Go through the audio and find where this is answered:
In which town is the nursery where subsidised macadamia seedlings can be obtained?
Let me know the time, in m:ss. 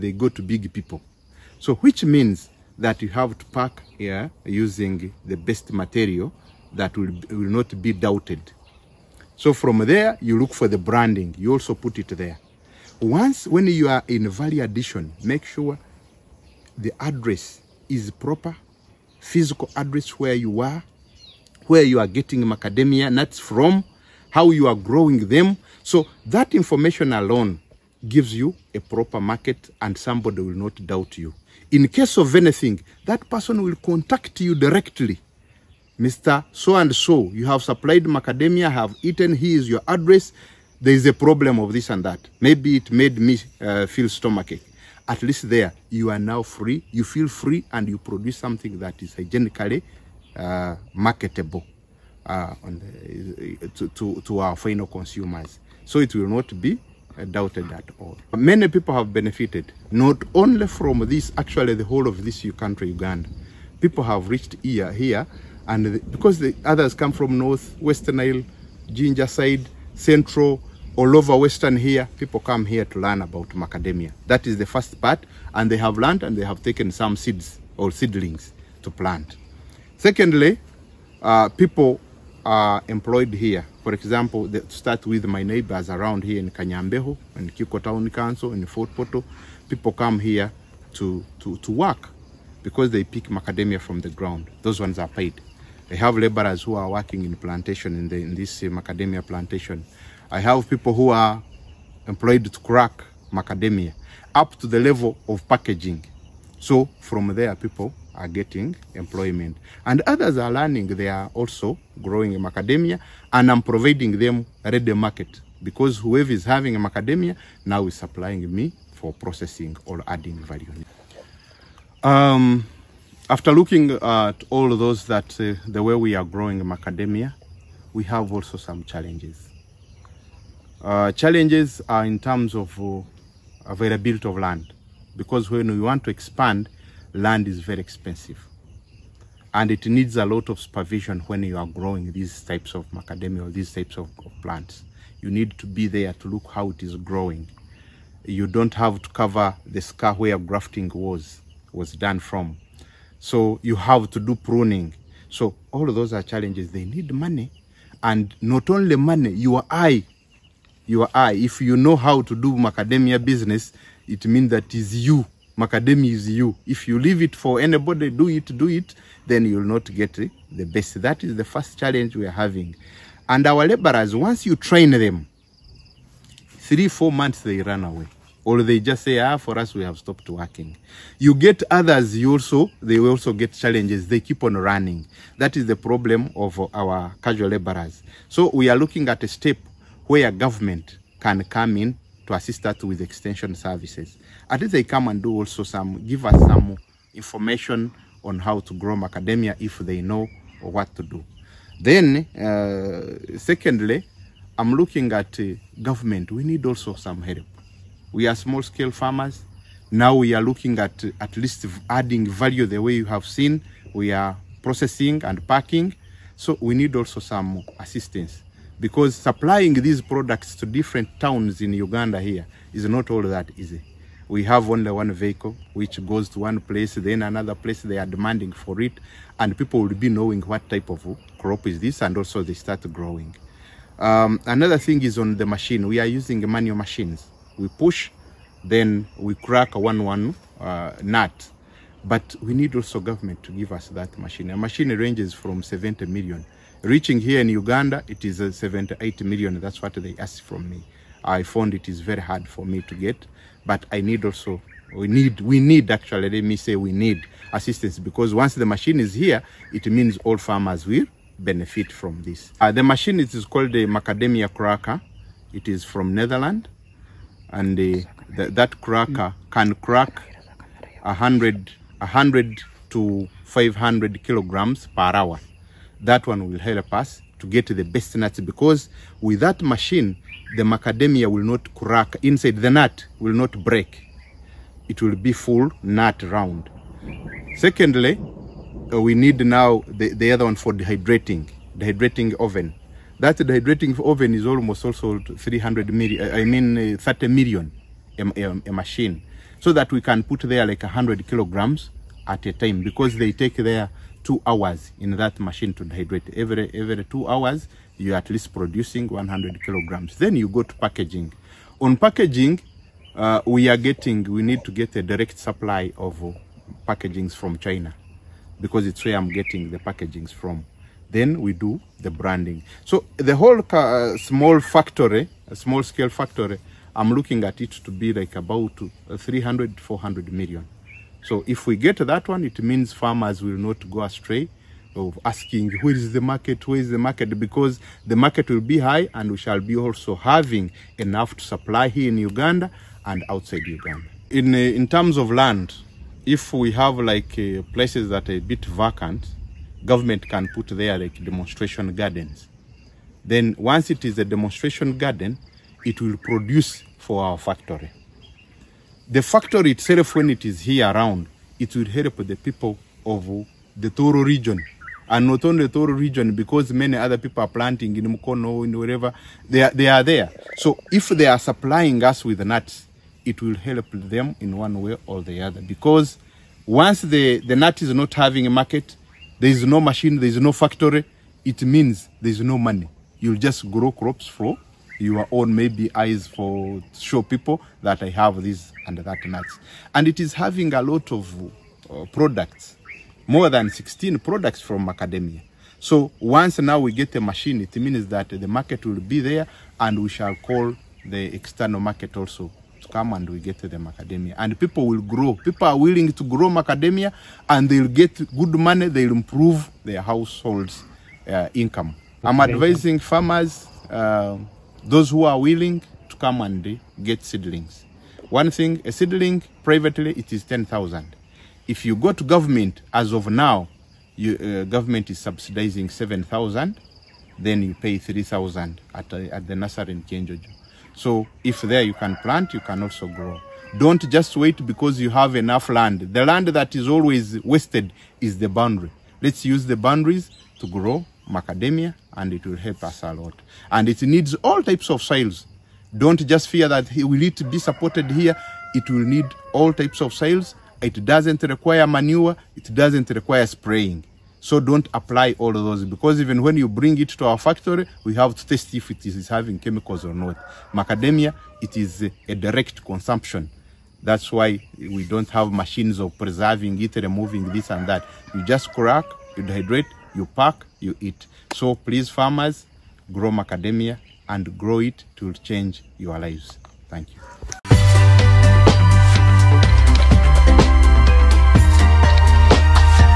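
7:10.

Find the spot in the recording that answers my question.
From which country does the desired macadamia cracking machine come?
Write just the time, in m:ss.
4:26.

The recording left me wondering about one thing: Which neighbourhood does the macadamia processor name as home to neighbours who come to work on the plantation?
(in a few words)
Kanyambeho.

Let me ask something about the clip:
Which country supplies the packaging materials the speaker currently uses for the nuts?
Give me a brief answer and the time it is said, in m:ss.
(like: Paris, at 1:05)
China, at 5:17.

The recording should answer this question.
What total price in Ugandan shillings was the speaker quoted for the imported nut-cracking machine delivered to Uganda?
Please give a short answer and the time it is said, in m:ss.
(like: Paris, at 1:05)
78 million, at 4:08.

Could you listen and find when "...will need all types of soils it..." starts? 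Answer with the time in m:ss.
7:28.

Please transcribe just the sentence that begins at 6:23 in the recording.
You'll just grow crops for your own maybe eyes for show people that I have this and that nuts.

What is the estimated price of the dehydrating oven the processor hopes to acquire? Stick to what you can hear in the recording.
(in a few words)
30 million.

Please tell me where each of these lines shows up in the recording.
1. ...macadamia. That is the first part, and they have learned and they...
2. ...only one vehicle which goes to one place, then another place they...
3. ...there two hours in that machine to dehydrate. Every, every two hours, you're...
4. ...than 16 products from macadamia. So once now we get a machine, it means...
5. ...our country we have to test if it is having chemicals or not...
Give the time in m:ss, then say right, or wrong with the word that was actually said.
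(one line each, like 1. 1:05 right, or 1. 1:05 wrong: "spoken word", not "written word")
1. 1:13 right
2. 3:44 right
3. 5:03 right
4. 6:33 right
5. 7:37 wrong: "factory", not "country".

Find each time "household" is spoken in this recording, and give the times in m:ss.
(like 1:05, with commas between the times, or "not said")
6:50.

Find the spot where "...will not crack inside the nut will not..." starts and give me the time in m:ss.
4:41.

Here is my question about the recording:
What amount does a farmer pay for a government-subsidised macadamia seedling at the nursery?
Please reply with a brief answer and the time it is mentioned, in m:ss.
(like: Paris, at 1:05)
3,000, at 7:07.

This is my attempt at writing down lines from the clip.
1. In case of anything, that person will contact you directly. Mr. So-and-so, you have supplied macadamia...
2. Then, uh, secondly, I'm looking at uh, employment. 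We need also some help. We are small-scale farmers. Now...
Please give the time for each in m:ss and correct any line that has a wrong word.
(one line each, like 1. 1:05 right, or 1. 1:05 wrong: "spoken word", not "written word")
1. 0:31 right
2. 3:21 wrong: "government", not "employment".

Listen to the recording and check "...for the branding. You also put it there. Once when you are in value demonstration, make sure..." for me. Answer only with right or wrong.
wrong.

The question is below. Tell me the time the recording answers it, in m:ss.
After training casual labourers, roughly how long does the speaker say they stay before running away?
2:56.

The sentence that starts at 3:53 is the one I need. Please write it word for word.
Um, another thing is on the machine.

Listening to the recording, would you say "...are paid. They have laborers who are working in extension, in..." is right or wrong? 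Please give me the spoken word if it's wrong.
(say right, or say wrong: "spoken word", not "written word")
wrong: "plantation", not "extension".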